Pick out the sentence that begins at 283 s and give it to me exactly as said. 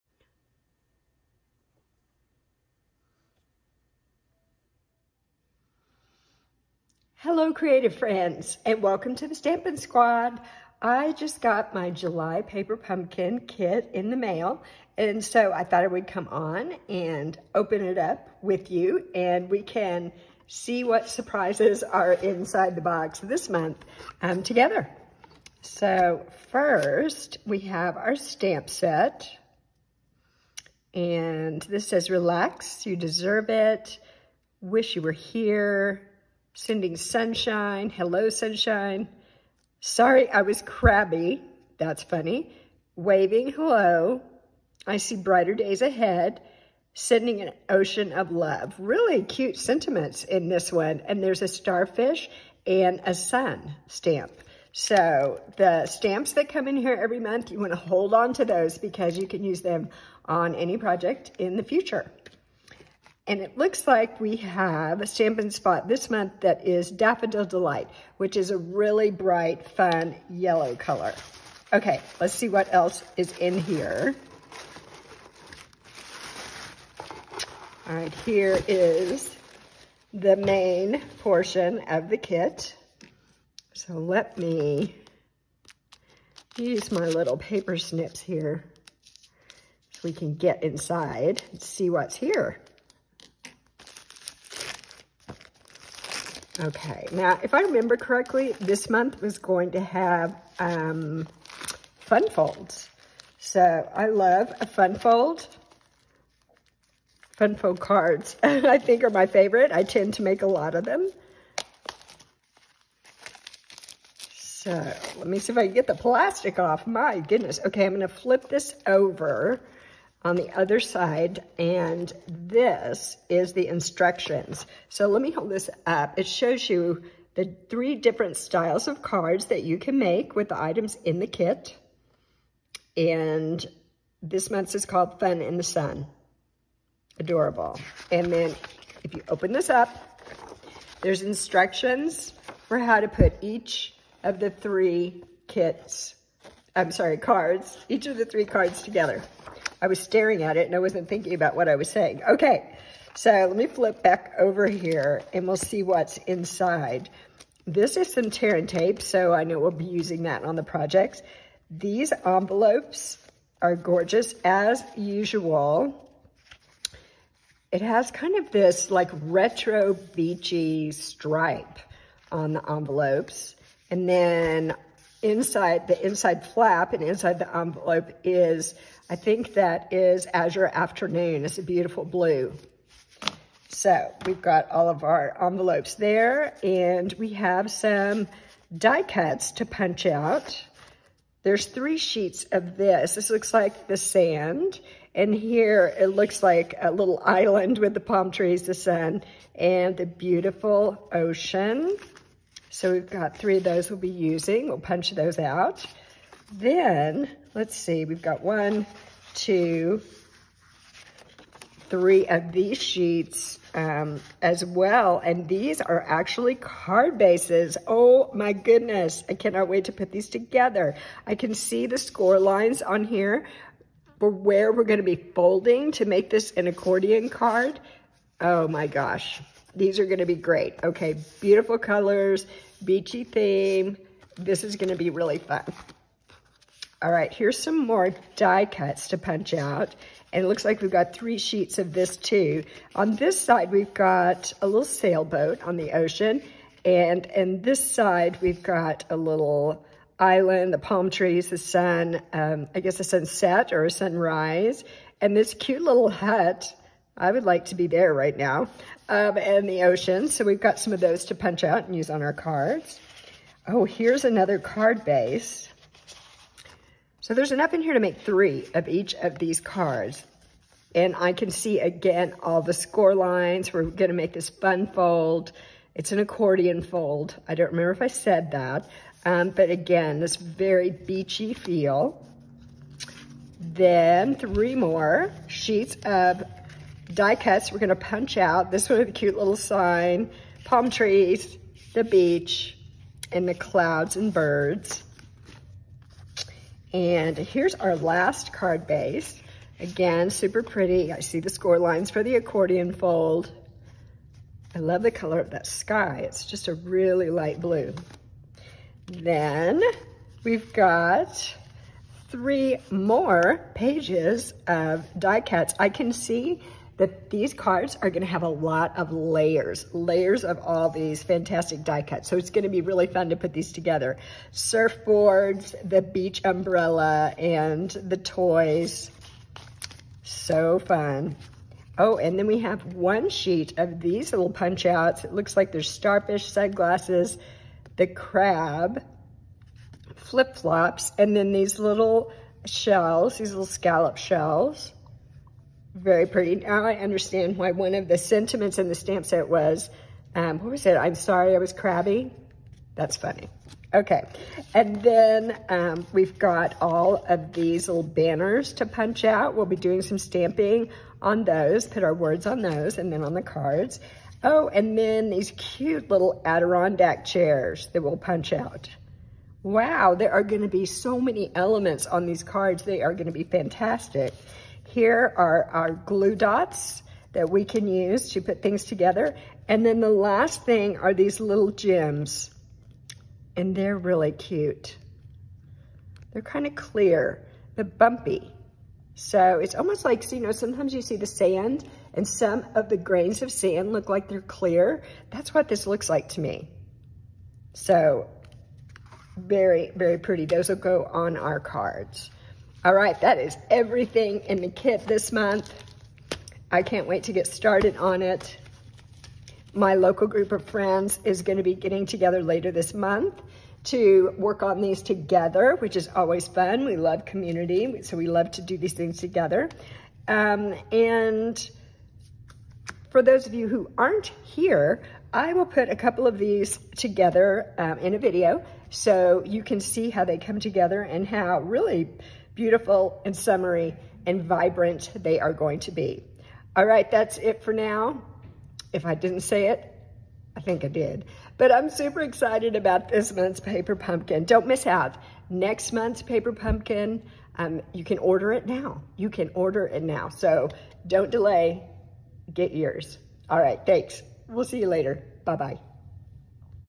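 Then three more sheets of die cuts we're going to punch out.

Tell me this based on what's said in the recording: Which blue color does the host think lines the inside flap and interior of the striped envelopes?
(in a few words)
Azure Afternoon.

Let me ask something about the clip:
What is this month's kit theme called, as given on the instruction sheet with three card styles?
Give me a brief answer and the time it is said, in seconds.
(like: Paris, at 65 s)
Fun in the Sun, at 135 s.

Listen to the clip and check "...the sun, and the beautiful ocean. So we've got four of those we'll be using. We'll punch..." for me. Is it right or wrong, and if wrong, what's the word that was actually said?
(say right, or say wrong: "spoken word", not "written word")
wrong: "three", not "four".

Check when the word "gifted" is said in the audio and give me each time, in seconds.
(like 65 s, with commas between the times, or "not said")
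not said.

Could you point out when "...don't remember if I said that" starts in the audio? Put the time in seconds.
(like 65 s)
277 s.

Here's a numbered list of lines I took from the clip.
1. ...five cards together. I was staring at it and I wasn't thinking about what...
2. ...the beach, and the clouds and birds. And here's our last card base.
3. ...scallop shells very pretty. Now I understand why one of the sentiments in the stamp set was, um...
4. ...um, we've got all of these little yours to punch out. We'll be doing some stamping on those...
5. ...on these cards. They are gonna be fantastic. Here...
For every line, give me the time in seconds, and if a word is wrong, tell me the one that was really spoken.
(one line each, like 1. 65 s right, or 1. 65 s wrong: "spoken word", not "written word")
1. 148 s wrong: "three", not "five"
2. 291 s right
3. 343 s right
4. 355 s wrong: "banners", not "yours"
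5. 372 s right.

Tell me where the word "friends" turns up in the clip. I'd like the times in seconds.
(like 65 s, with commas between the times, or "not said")
7 s, 410 s.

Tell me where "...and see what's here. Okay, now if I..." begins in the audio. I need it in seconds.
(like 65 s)
91 s.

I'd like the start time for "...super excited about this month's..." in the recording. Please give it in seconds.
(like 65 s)
441 s.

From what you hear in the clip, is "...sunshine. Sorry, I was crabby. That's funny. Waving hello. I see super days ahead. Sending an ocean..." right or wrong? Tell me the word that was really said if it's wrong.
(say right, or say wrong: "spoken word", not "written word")
wrong: "brighter", not "super".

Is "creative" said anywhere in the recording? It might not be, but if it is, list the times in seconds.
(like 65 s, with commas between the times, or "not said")
7 s.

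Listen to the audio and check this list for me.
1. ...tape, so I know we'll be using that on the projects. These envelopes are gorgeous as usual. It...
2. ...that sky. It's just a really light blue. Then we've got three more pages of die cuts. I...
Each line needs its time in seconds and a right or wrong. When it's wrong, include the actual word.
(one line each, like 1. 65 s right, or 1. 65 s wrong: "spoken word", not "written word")
1. 158 s right
2. 305 s right.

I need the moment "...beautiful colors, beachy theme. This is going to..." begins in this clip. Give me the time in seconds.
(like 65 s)
231 s.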